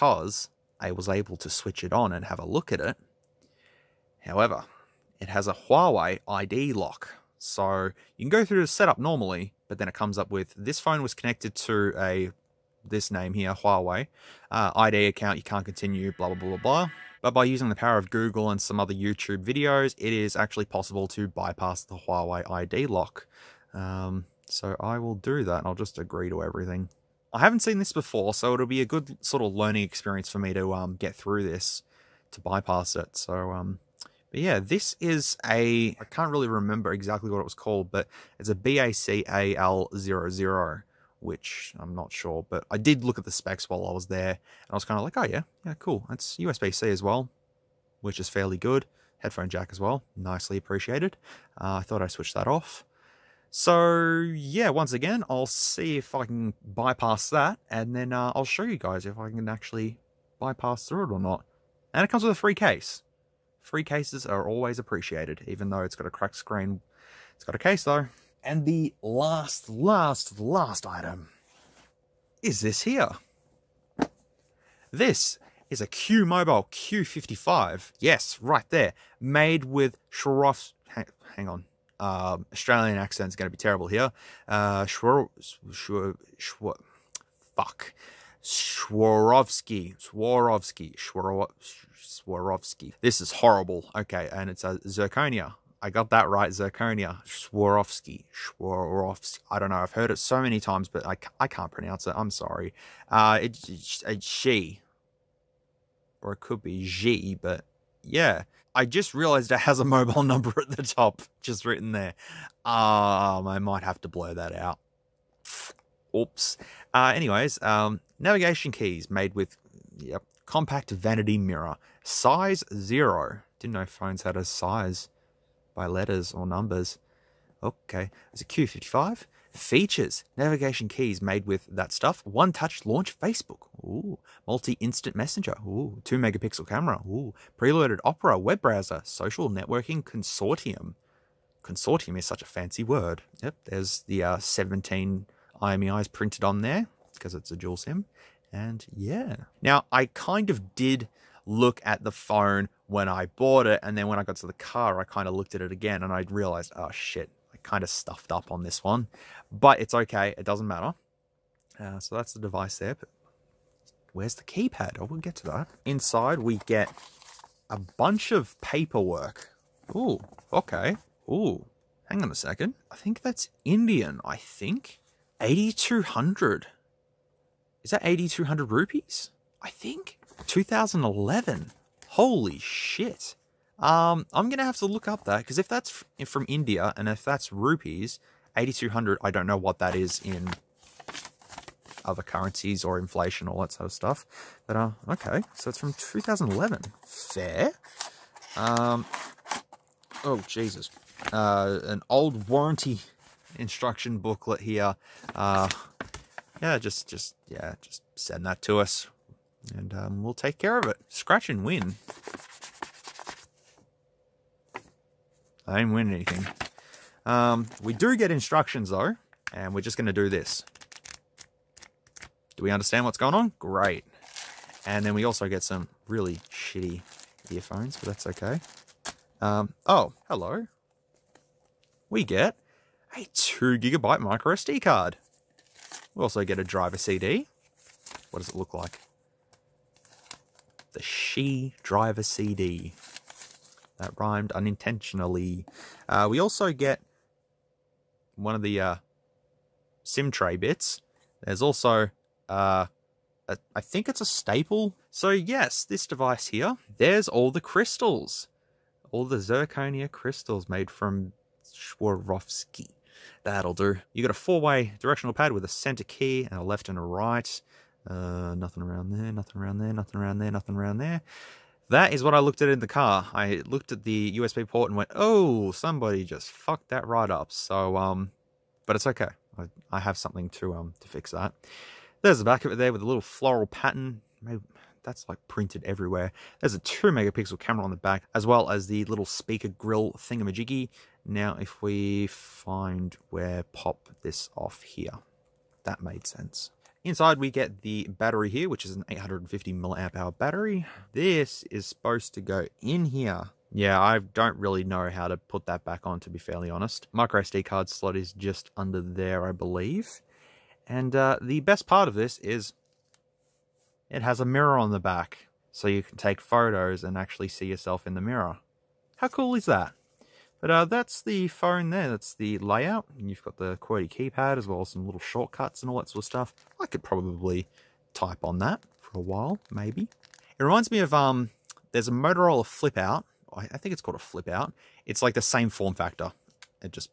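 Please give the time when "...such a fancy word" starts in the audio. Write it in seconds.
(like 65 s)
142 s.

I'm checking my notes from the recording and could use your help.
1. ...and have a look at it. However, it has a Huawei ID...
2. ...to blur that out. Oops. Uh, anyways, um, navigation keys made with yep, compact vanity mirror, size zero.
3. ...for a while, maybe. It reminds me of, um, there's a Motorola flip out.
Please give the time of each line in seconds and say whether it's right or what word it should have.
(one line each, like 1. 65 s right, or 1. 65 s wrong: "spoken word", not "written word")
1. 2 s right
2. 114 s right
3. 329 s right.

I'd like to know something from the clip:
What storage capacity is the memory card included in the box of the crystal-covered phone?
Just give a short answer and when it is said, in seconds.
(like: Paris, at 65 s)
2 gigabytes, at 233 s.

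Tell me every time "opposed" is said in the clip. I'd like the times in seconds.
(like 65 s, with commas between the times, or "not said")
not said.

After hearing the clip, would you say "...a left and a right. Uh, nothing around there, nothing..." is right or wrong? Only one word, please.
right.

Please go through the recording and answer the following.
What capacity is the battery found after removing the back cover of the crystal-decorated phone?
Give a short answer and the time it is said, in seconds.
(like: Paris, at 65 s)
850 mAh, at 299 s.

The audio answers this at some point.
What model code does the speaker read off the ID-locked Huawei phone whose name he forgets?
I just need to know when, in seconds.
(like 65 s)
38 s.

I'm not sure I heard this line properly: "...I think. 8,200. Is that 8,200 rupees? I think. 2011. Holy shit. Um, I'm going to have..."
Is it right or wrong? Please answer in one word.
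right.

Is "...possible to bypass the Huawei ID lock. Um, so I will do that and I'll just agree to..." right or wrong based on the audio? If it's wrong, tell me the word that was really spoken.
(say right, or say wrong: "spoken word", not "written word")
right.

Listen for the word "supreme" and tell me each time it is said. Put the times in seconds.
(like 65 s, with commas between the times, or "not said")
not said.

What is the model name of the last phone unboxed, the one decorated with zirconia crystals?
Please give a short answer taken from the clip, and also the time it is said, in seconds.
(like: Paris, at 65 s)
Q Mobile Q55, at 75 s.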